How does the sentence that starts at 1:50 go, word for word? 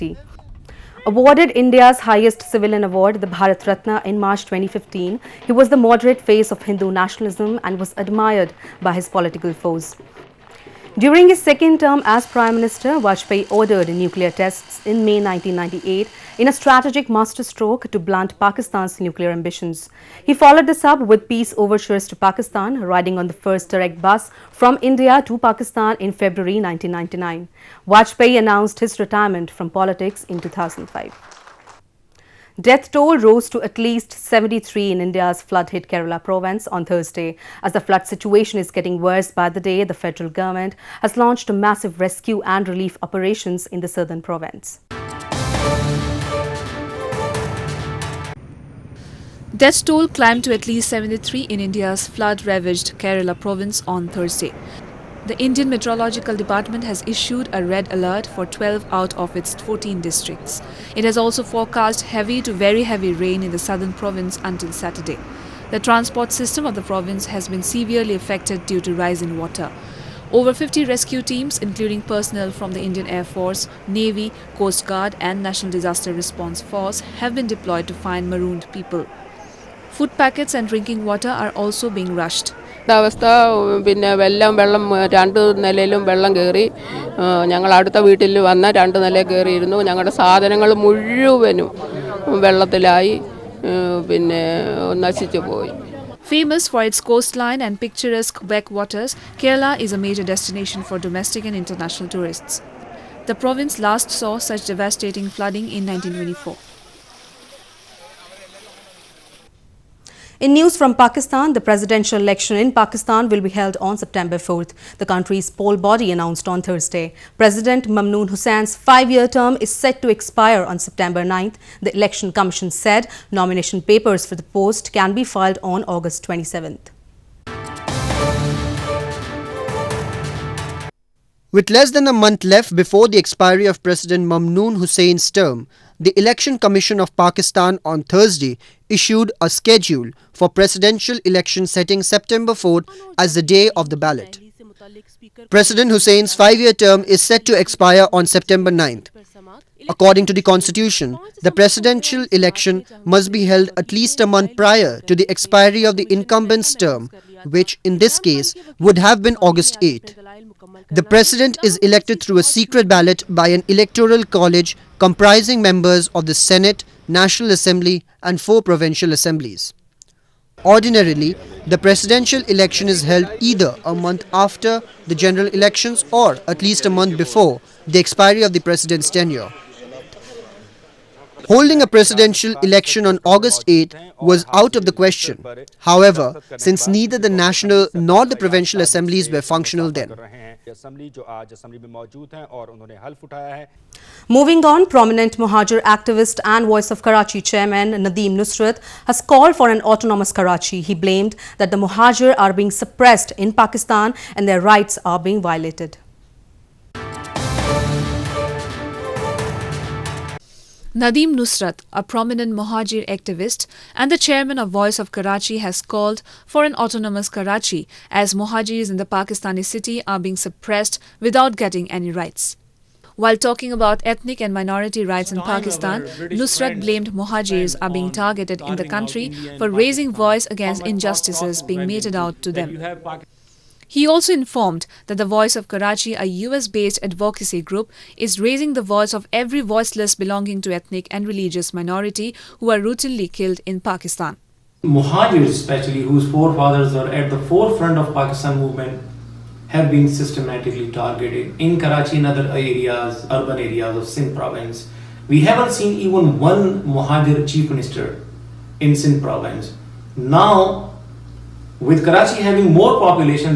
In news from Pakistan, the presidential election in Pakistan will be held on September 4th, the country's poll body announced on Thursday.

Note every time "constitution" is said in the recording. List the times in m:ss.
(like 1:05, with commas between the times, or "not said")
2:30.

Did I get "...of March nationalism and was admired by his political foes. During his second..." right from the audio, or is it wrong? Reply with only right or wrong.
wrong.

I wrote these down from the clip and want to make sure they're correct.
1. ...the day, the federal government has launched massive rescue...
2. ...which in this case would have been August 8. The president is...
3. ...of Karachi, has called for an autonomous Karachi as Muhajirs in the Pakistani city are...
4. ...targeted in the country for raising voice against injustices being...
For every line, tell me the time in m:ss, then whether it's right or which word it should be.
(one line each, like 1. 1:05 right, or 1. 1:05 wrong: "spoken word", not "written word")
1. 0:39 right
2. 2:37 right
3. 3:34 right
4. 3:48 right.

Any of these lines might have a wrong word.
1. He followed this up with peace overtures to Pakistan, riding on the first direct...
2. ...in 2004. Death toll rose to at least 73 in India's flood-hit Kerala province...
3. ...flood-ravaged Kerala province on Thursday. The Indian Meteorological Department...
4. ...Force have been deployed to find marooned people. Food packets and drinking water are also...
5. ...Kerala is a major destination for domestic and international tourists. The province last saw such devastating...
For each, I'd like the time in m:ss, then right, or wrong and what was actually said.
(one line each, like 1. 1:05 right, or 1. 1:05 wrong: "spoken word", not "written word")
1. 0:20 right
2. 0:30 wrong: "2005", not "2004"
3. 0:52 right
4. 1:16 right
5. 1:39 right.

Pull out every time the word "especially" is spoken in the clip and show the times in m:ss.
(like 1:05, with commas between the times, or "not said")
4:05.